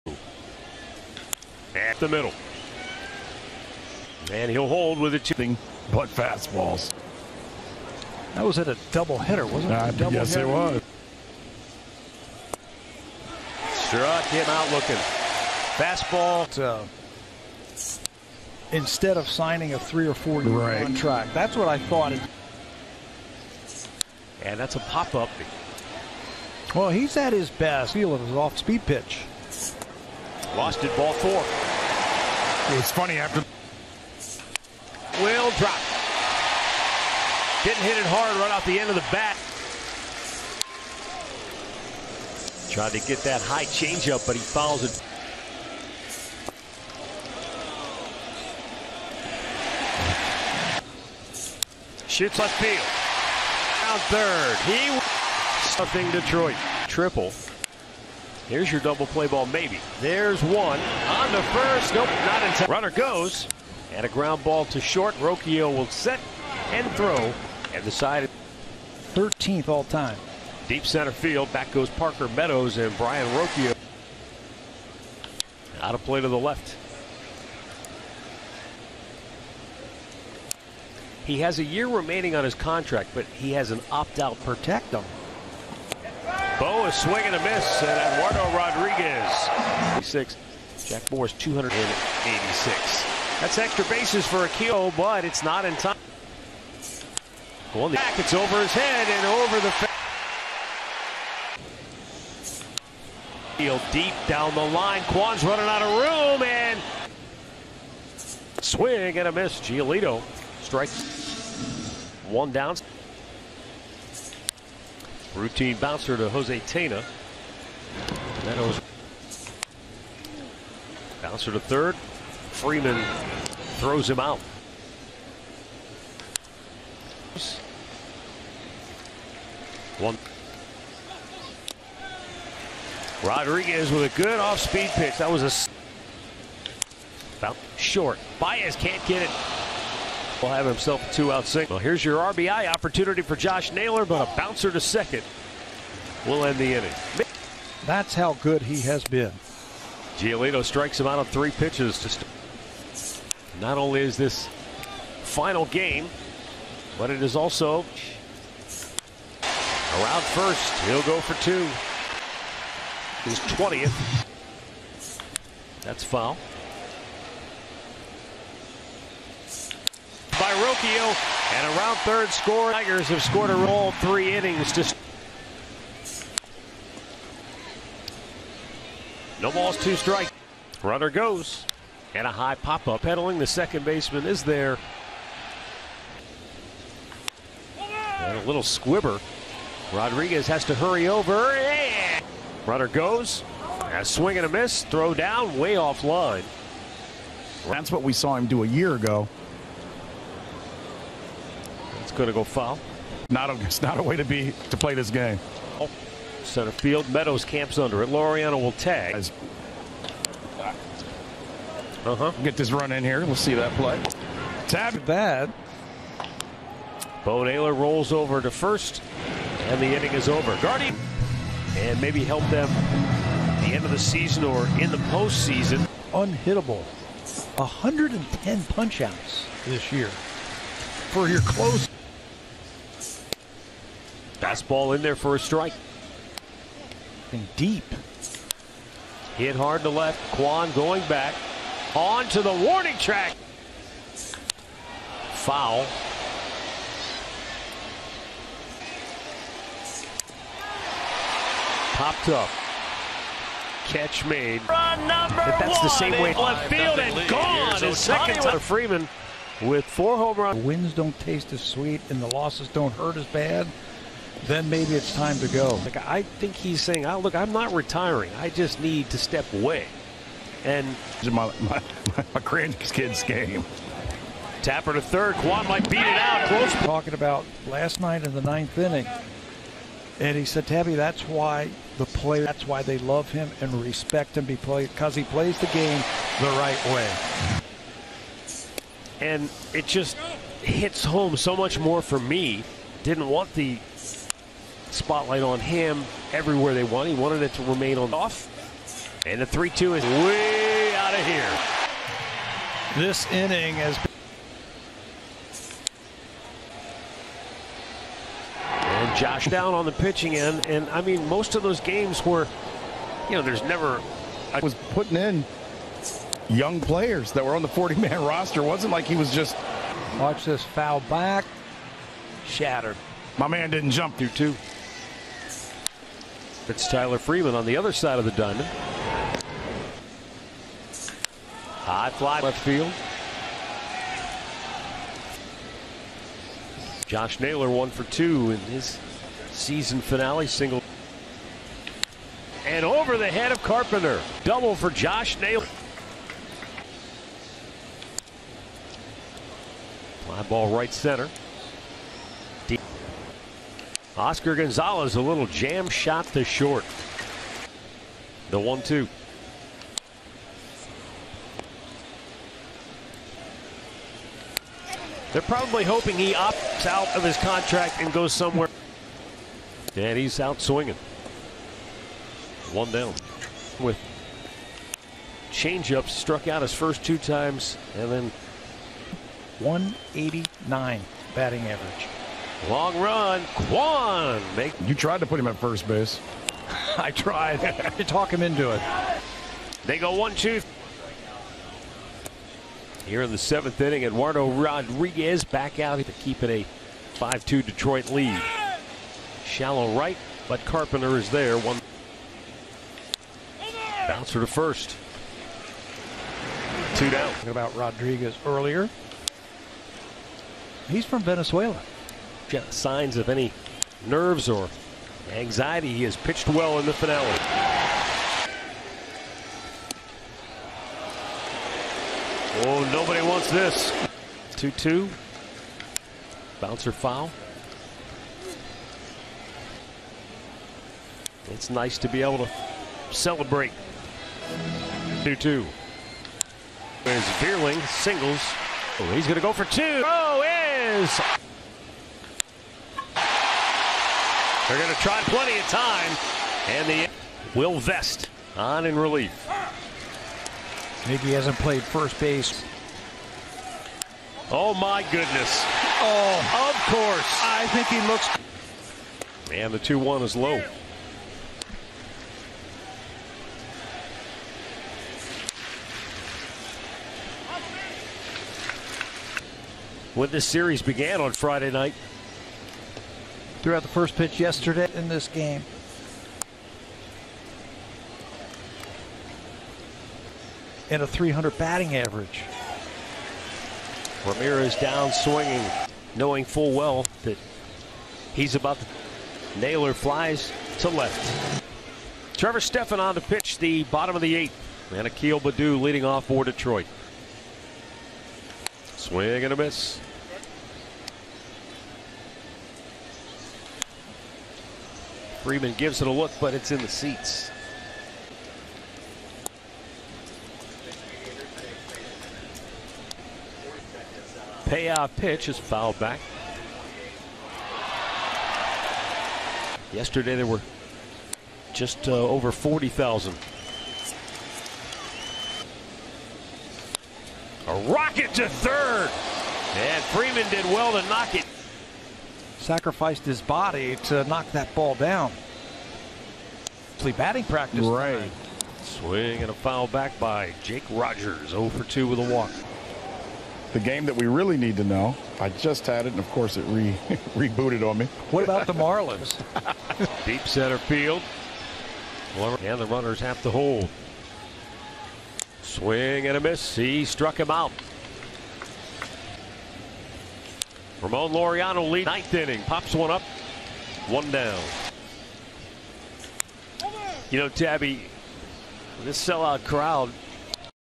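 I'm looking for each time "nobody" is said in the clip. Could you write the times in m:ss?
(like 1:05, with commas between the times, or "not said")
7:02.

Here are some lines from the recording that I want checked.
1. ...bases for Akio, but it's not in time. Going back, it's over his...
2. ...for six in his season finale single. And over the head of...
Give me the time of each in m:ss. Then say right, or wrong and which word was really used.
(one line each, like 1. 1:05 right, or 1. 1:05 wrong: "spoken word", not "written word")
1. 1:33 right
2. 5:37 wrong: "two", not "six".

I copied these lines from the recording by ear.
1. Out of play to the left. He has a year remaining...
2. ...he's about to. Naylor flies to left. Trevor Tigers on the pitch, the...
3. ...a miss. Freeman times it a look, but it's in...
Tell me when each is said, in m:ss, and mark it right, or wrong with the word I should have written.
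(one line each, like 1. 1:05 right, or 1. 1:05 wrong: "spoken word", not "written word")
1. 1:15 right
2. 8:08 wrong: "Stephan", not "Tigers"
3. 8:19 wrong: "gives", not "times".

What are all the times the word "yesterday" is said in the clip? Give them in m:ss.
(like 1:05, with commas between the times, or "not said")
7:54, 8:39.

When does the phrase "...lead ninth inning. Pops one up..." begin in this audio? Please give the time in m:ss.
9:21.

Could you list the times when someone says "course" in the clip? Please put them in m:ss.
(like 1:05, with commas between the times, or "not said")
7:36, 9:06.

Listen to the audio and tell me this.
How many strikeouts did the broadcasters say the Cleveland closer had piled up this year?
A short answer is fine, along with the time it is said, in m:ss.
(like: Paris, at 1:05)
110, at 3:47.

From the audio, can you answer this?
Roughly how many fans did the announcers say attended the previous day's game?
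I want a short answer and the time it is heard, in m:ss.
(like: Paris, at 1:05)
over 40,000, at 8:42.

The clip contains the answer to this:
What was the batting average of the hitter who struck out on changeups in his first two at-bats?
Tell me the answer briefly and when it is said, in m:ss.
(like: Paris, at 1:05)
189, at 6:19.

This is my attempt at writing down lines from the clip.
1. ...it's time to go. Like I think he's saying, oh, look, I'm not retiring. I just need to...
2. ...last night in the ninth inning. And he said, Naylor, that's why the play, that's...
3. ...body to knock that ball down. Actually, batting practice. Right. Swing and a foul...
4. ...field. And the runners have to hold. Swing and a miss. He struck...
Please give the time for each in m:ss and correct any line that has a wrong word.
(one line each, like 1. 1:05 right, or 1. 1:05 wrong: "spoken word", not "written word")
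1. 4:24 right
2. 4:37 wrong: "Tabby", not "Naylor"
3. 8:53 right
4. 9:10 right.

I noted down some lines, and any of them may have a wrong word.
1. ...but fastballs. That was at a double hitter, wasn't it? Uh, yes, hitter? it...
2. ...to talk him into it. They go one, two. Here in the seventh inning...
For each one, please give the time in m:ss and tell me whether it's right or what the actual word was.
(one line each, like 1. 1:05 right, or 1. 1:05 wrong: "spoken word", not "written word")
1. 0:05 right
2. 6:27 right.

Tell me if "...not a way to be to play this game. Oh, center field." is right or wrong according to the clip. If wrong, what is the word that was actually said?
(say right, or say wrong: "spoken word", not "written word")
right.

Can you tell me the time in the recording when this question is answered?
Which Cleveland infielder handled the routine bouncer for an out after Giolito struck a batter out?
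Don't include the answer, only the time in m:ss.
1:56.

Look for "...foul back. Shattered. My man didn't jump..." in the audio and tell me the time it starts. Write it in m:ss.
5:20.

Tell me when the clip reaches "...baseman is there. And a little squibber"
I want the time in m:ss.
3:03.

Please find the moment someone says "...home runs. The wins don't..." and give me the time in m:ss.
4:20.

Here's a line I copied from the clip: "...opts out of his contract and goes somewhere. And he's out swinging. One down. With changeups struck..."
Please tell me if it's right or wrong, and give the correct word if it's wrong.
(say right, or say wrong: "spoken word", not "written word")
right.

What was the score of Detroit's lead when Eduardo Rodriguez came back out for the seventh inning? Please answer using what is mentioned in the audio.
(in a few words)
5-2.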